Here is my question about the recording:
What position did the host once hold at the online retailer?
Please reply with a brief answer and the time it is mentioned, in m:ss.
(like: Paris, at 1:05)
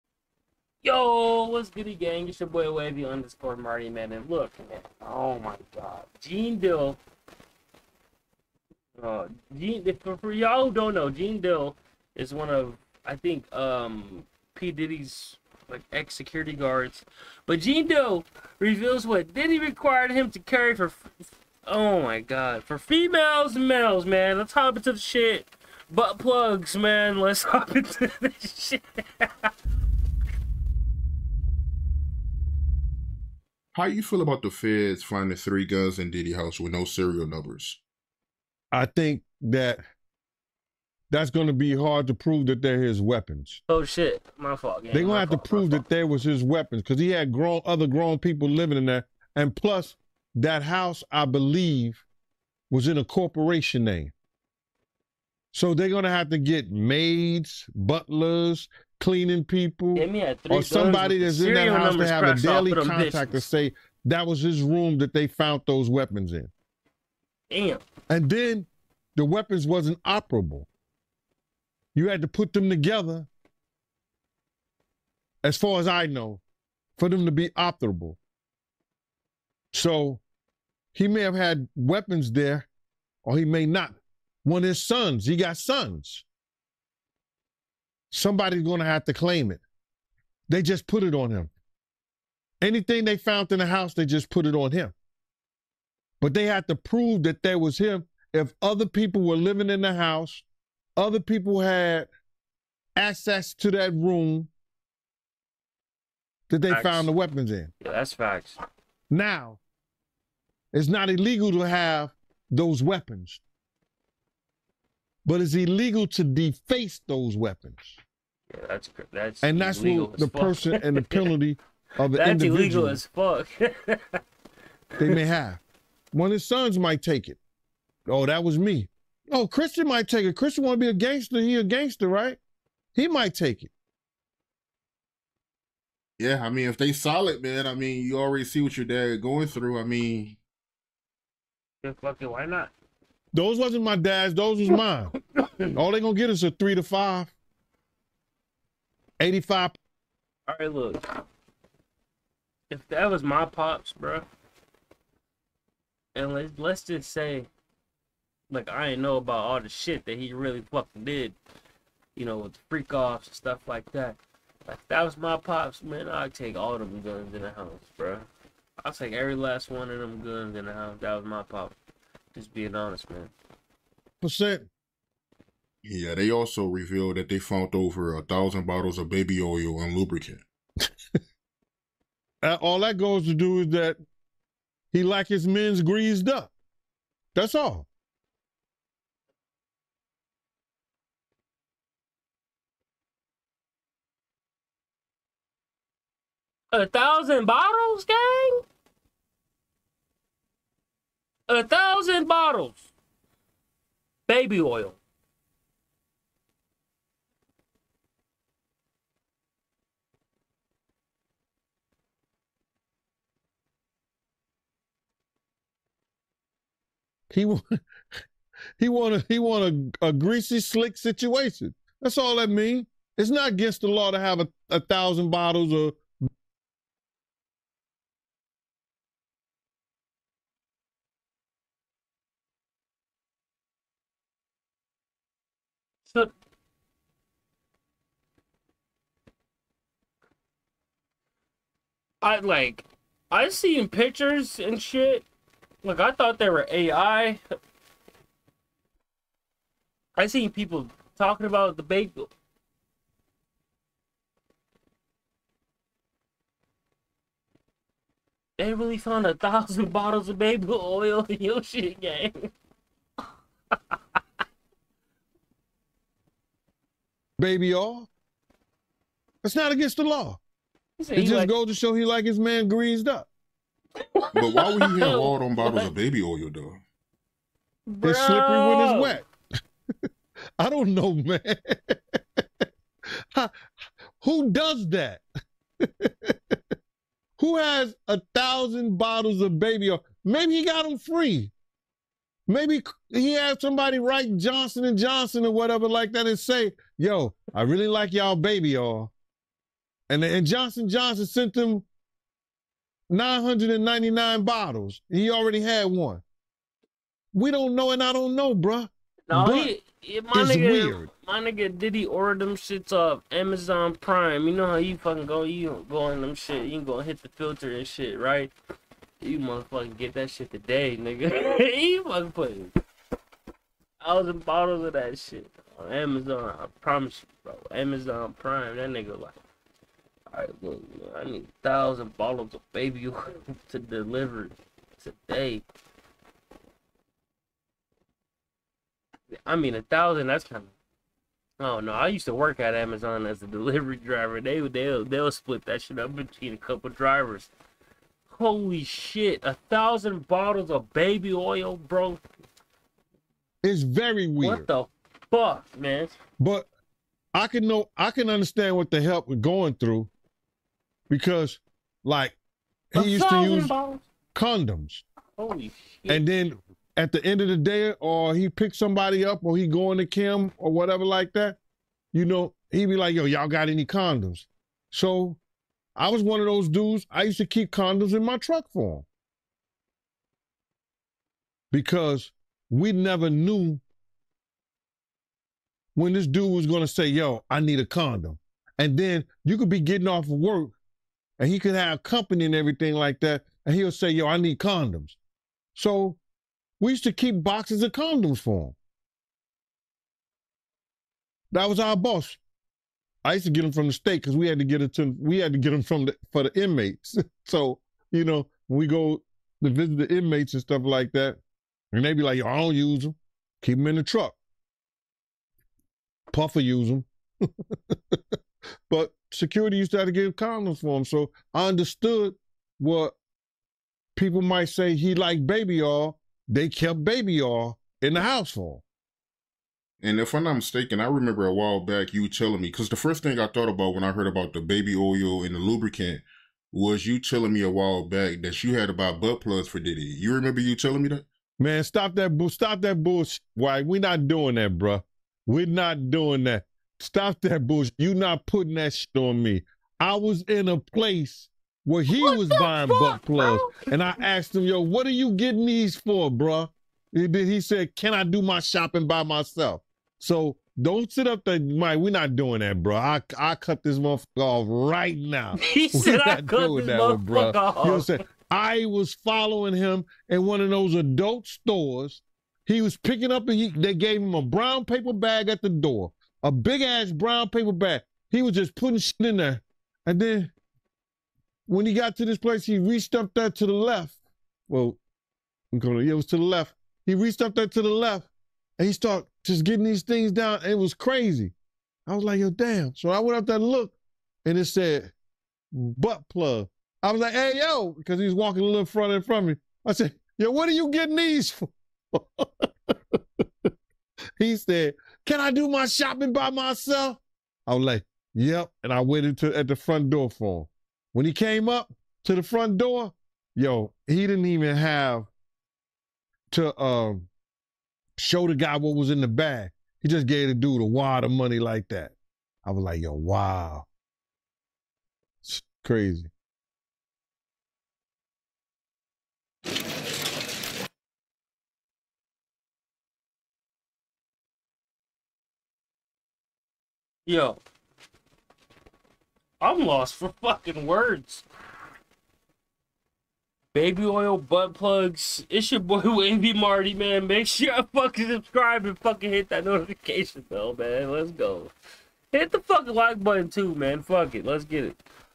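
Delivery driver, at 5:43.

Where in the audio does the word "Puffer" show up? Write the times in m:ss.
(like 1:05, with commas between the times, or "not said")
6:56.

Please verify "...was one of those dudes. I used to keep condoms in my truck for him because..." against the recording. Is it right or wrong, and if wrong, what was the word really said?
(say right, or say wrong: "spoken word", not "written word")
right.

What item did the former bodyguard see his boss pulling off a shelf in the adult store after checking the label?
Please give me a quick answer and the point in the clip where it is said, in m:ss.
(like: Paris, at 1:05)
Butt plug, at 8:15.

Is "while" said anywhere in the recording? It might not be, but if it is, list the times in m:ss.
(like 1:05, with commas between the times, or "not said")
7:11, 7:17.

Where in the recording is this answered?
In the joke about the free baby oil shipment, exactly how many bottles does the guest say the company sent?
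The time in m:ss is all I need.
5:03.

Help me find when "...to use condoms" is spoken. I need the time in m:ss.
6:03.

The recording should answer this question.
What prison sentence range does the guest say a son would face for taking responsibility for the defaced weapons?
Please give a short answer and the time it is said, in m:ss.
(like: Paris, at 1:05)
3 to 5, at 2:26.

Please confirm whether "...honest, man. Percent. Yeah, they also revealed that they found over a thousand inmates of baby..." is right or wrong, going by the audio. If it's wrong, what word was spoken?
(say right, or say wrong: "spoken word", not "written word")
wrong: "bottles", not "inmates".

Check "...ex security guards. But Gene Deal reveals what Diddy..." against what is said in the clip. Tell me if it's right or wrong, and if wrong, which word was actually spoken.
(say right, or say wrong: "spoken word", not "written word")
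right.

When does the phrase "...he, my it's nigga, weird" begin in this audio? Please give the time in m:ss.
5:10.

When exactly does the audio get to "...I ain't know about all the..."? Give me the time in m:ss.
2:38.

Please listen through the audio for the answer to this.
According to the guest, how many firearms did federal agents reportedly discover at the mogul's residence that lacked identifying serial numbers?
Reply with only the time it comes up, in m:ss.
0:35.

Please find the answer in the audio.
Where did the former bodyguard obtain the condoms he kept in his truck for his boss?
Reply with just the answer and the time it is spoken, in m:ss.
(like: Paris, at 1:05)
From the state, at 6:43.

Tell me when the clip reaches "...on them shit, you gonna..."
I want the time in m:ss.
5:15.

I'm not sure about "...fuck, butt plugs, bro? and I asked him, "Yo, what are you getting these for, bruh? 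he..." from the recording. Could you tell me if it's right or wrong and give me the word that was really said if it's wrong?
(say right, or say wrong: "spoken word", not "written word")
right.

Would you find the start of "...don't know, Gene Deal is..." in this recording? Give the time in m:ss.
0:10.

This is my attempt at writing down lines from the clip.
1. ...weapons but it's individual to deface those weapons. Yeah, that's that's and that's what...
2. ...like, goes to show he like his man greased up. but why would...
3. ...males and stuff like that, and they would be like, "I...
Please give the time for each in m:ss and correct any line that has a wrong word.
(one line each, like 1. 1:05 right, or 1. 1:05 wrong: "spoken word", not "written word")
1. 1:52 wrong: "illegal", not "individual"
2. 4:31 right
3. 6:50 wrong: "inmates", not "males".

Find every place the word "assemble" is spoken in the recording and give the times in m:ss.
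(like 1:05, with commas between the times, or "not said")
not said.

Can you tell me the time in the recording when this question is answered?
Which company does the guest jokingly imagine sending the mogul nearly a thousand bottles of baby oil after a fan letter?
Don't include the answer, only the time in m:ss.
4:54.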